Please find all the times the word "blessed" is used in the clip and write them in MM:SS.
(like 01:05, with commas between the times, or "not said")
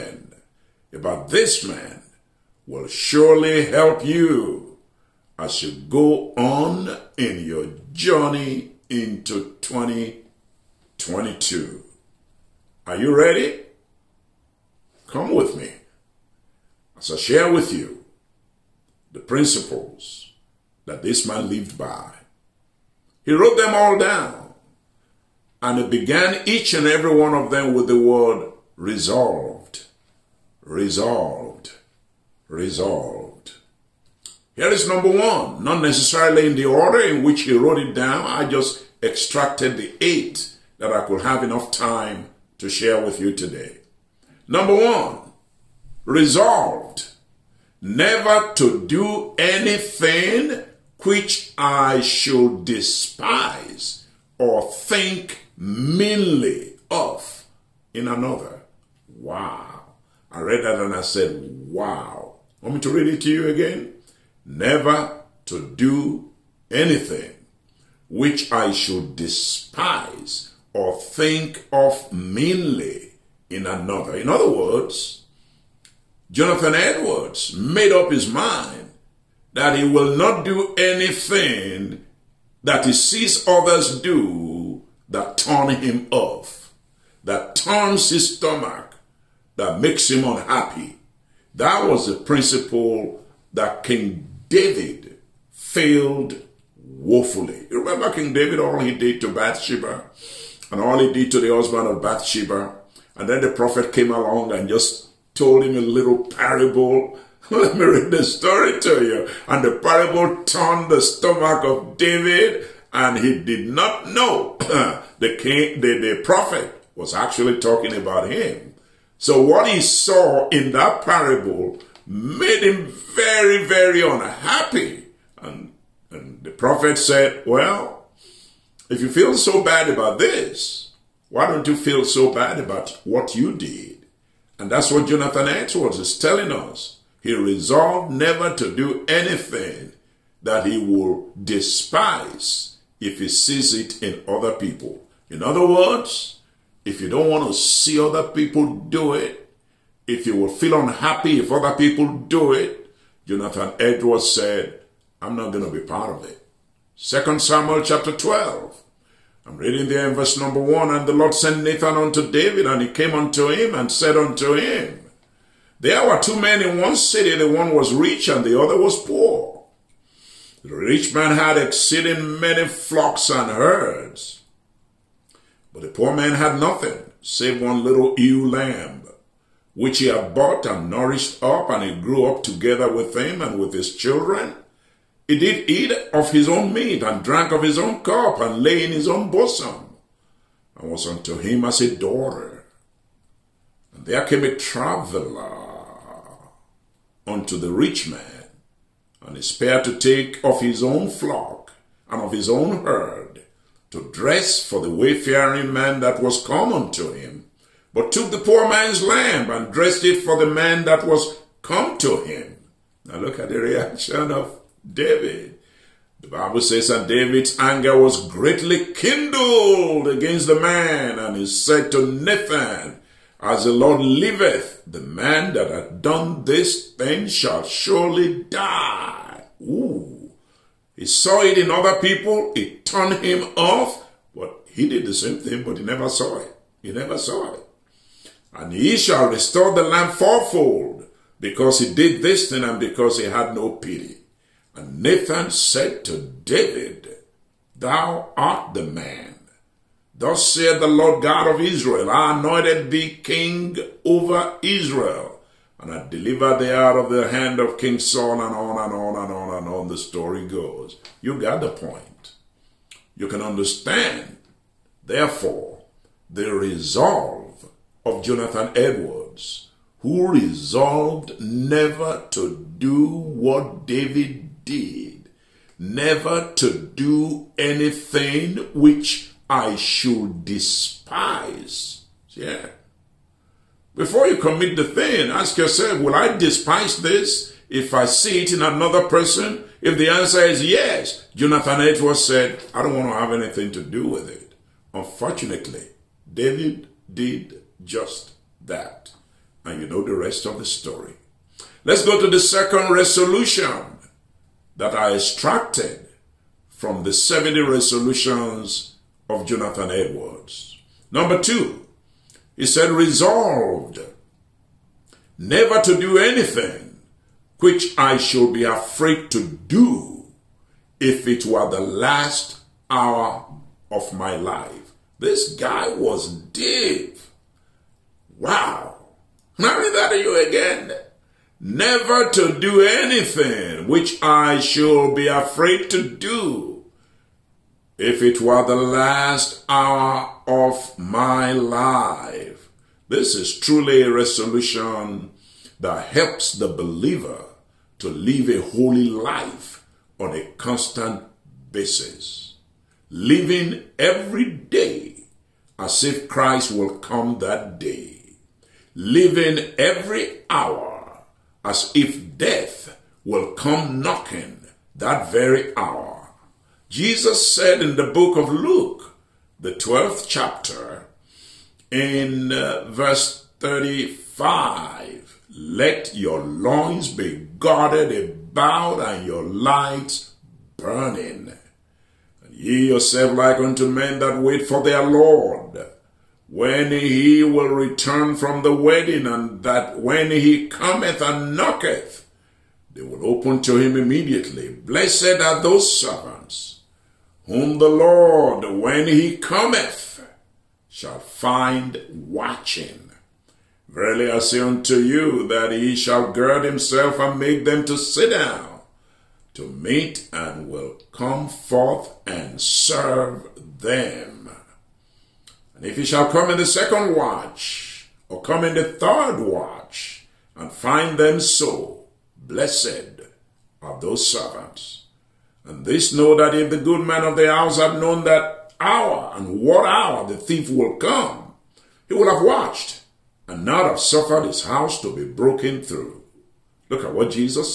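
06:34, 07:02.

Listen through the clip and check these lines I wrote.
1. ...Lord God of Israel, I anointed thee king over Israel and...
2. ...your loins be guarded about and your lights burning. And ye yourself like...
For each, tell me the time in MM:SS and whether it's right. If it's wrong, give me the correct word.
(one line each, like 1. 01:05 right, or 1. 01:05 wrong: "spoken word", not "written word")
1. 04:10 right
2. 06:16 right.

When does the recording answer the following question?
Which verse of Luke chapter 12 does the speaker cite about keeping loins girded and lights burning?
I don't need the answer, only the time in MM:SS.
06:12.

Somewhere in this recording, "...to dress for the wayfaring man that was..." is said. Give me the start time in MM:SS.
03:23.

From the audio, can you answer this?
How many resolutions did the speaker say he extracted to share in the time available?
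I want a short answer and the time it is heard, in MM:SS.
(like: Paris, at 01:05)
8, at 00:39.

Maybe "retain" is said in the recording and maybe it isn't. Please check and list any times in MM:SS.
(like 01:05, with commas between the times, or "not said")
not said.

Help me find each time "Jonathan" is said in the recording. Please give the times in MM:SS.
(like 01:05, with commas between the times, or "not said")
01:16, 02:15, 02:33, 04:28, 04:51, 05:09.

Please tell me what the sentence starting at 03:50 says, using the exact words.
He saw it in other people.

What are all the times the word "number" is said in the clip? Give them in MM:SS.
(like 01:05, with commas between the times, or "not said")
00:34, 00:44, 02:40, 05:11.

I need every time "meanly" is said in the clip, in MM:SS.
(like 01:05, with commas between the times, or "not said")
00:55, 01:12.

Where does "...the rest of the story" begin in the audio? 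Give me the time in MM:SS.
05:00.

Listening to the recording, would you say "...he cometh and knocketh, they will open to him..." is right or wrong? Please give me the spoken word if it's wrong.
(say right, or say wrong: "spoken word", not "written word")
right.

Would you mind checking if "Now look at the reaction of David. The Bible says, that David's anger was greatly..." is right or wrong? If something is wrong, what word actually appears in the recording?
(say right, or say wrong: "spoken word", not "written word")
right.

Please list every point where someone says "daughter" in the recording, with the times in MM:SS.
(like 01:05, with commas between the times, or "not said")
03:11.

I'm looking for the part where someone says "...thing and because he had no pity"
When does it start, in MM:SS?
04:02.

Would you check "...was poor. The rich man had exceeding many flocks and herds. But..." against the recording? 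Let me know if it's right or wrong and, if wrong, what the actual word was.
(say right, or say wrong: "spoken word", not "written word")
right.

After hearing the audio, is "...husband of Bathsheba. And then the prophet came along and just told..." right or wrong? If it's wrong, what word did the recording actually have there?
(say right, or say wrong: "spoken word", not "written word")
right.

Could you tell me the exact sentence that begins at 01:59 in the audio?
So what he saw in that parable made him very, very unhappy.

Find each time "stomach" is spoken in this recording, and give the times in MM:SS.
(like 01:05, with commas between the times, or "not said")
01:28, 01:51.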